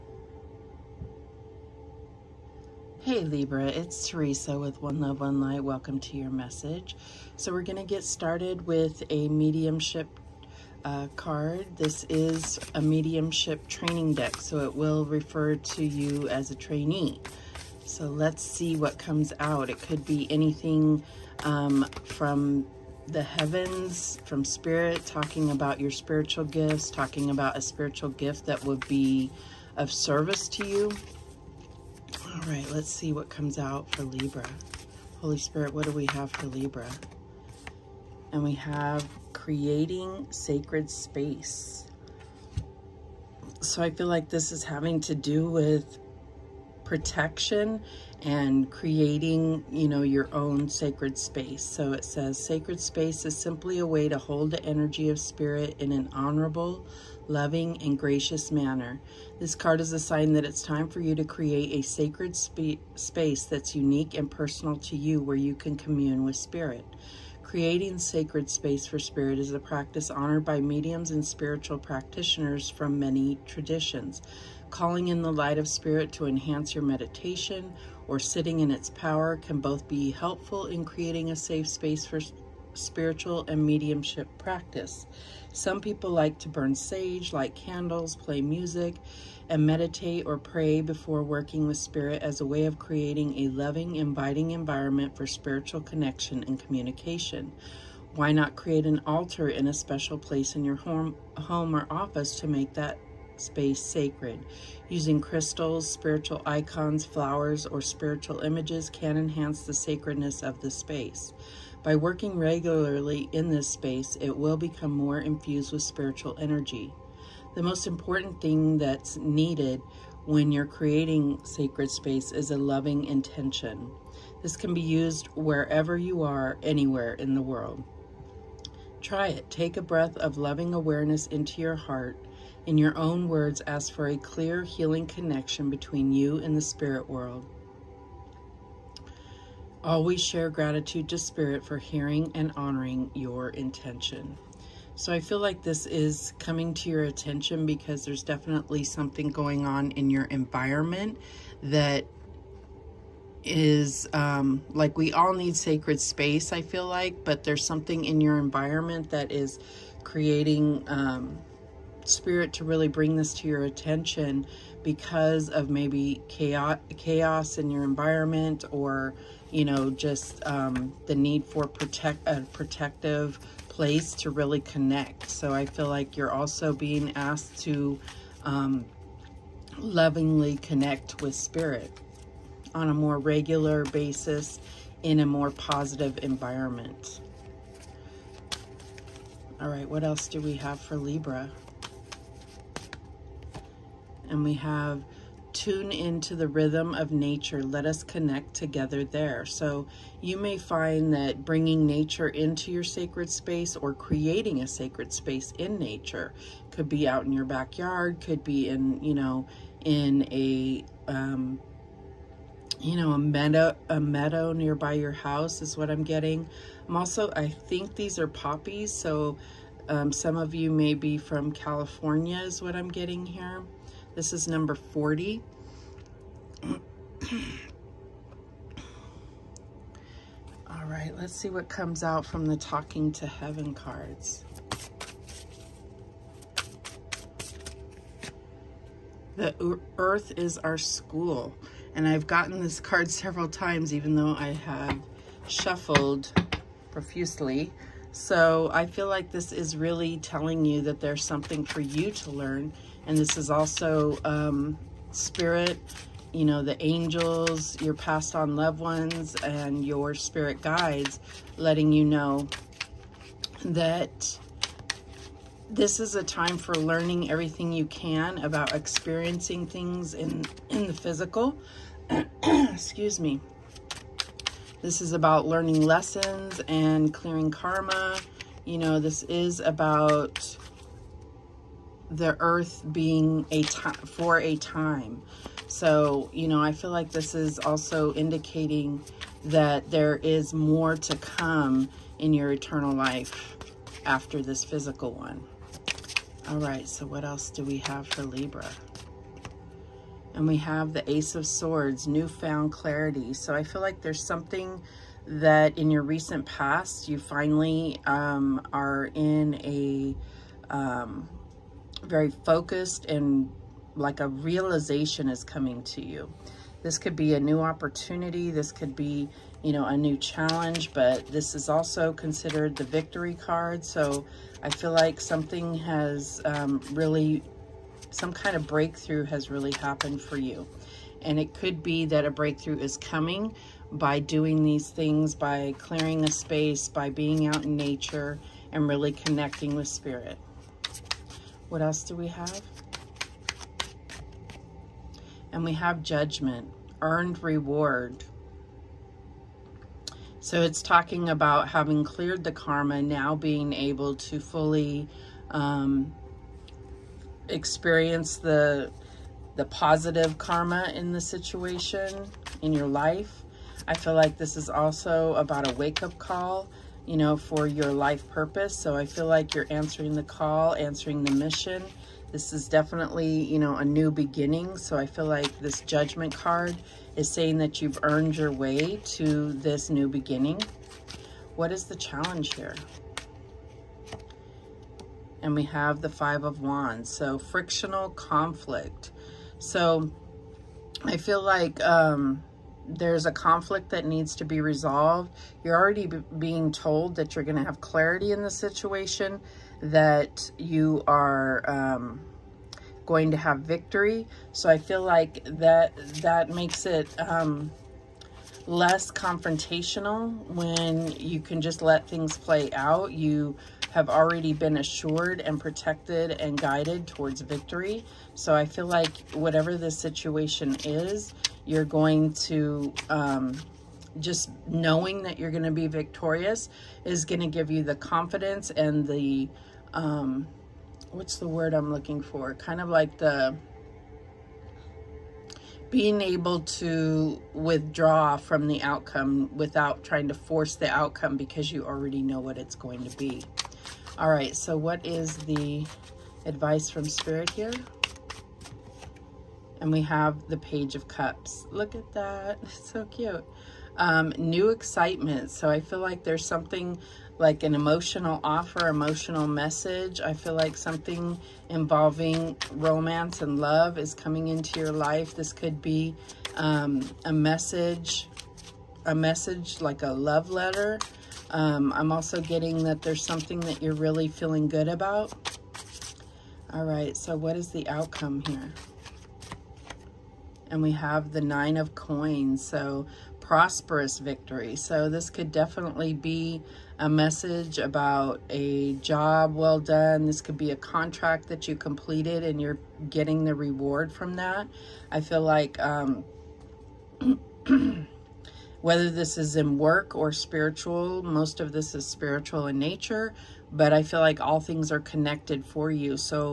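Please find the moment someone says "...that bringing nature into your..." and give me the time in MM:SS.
03:21.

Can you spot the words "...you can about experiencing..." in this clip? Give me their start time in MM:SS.
04:27.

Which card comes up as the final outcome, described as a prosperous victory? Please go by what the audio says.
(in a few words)
Nine of Coins.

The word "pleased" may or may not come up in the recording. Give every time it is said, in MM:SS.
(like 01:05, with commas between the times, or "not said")
not said.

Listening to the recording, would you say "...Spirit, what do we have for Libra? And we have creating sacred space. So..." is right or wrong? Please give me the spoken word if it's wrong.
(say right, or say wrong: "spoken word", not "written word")
right.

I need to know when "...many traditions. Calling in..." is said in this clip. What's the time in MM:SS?
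01:12.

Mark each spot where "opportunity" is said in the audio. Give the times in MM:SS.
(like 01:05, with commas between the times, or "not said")
05:17.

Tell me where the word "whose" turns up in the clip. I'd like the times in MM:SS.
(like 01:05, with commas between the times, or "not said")
not said.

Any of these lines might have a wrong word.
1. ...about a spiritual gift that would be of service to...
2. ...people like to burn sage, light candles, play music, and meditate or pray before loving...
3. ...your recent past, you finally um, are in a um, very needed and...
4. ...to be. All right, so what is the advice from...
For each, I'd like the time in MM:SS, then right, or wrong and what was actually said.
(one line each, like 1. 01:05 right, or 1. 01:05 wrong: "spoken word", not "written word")
1. 00:27 right
2. 01:25 wrong: "working", not "loving"
3. 05:05 wrong: "focused", not "needed"
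4. 07:23 right.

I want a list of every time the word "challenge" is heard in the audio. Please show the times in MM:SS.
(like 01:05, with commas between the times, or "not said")
05:20, 06:21.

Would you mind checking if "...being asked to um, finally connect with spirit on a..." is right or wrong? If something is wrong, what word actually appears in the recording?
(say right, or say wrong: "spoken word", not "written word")
wrong: "lovingly", not "finally".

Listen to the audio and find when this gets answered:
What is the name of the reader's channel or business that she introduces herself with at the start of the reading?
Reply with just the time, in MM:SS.
00:04.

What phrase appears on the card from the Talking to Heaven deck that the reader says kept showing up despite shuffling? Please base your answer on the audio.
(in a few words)
The earth is our school.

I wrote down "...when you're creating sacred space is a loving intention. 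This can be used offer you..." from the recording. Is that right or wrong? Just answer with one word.
wrong.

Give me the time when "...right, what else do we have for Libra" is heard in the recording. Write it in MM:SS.
03:09.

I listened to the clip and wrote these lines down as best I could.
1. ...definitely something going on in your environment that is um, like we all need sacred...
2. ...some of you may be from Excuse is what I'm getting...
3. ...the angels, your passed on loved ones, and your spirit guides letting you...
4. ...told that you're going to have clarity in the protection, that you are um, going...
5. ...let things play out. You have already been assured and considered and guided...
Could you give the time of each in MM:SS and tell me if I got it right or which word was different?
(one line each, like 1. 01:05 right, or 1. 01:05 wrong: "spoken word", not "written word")
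1. 02:28 right
2. 03:40 wrong: "California", not "Excuse"
3. 04:16 right
4. 06:36 wrong: "situation", not "protection"
5. 06:51 wrong: "protected", not "considered".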